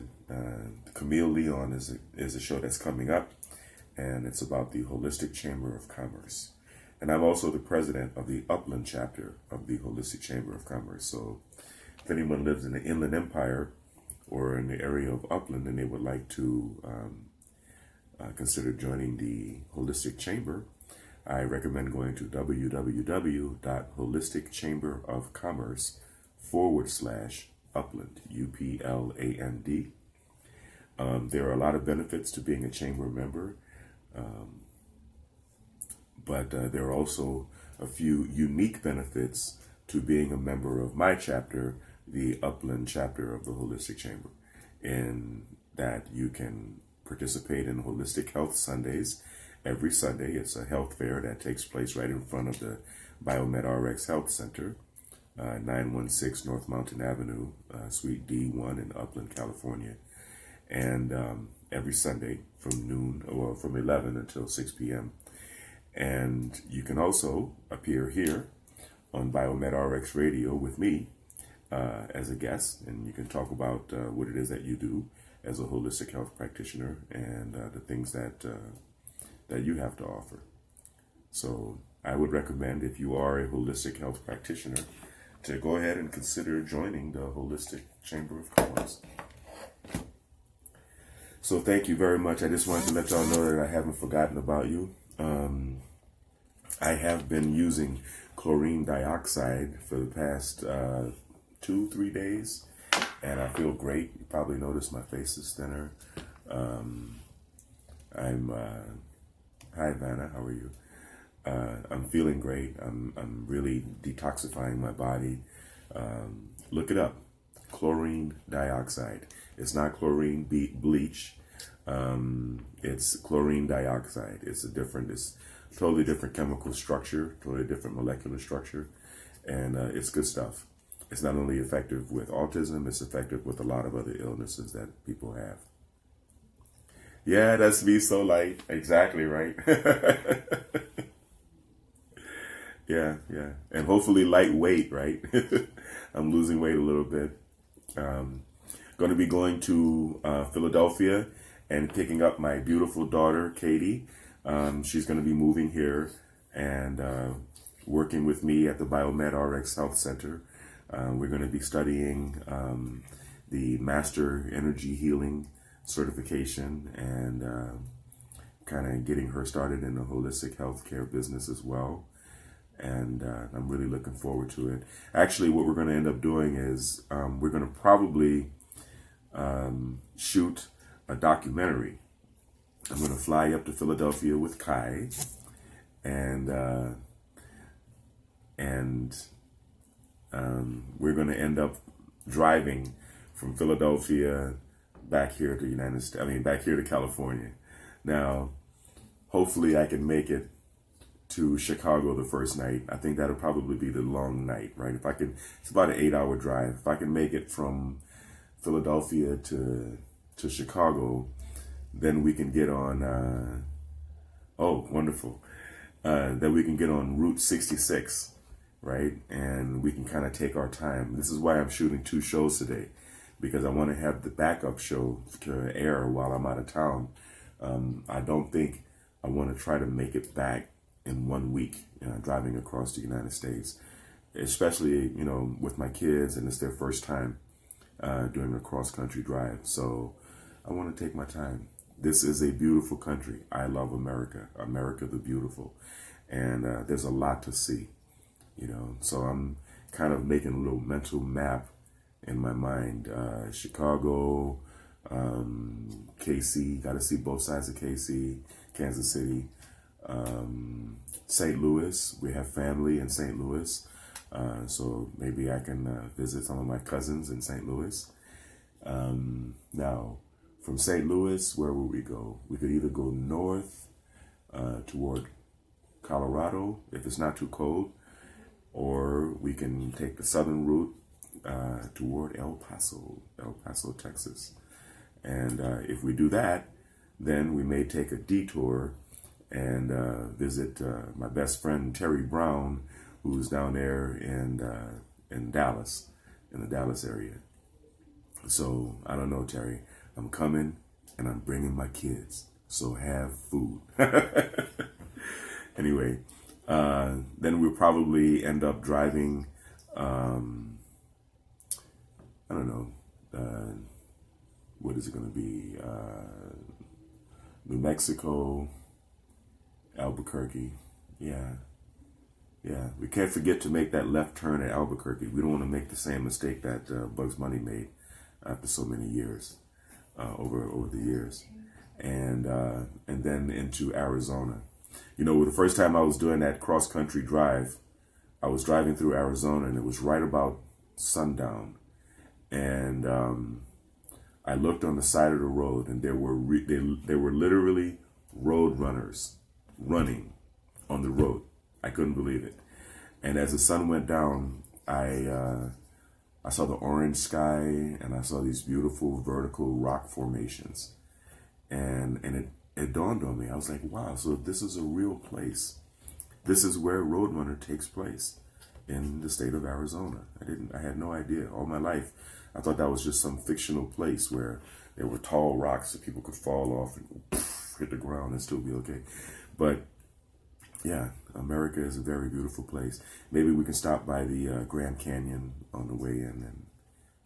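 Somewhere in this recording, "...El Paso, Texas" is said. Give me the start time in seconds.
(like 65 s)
283 s.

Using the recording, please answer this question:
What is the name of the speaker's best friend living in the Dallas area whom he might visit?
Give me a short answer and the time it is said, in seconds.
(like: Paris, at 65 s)
Terry Brown, at 291 s.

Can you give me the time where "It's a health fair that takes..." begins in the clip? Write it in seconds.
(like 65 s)
50 s.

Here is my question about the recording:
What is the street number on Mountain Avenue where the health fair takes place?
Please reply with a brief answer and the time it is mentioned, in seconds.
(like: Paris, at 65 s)
916, at 55 s.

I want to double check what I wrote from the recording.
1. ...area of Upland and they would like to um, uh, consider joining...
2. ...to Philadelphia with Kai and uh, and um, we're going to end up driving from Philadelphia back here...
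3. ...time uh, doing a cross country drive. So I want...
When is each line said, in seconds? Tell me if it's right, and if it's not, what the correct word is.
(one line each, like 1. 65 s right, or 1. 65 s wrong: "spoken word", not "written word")
1. 14 s right
2. 183 s right
3. 237 s right.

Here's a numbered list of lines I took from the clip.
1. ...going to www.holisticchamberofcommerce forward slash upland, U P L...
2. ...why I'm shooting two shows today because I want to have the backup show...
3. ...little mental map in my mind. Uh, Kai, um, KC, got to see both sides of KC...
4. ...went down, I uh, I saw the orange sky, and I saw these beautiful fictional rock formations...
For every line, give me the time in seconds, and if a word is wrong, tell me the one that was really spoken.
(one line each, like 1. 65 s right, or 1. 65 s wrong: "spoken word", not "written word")
1. 21 s right
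2. 221 s right
3. 250 s wrong: "Chicago", not "Kai"
4. 353 s wrong: "vertical", not "fictional".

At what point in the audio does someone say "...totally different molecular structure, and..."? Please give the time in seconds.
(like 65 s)
127 s.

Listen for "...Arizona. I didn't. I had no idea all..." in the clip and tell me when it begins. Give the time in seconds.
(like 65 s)
369 s.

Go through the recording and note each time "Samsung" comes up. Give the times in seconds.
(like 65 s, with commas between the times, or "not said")
not said.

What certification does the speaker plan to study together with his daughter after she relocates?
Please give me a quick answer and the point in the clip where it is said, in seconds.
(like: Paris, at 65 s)
Master Energy Healing, at 163 s.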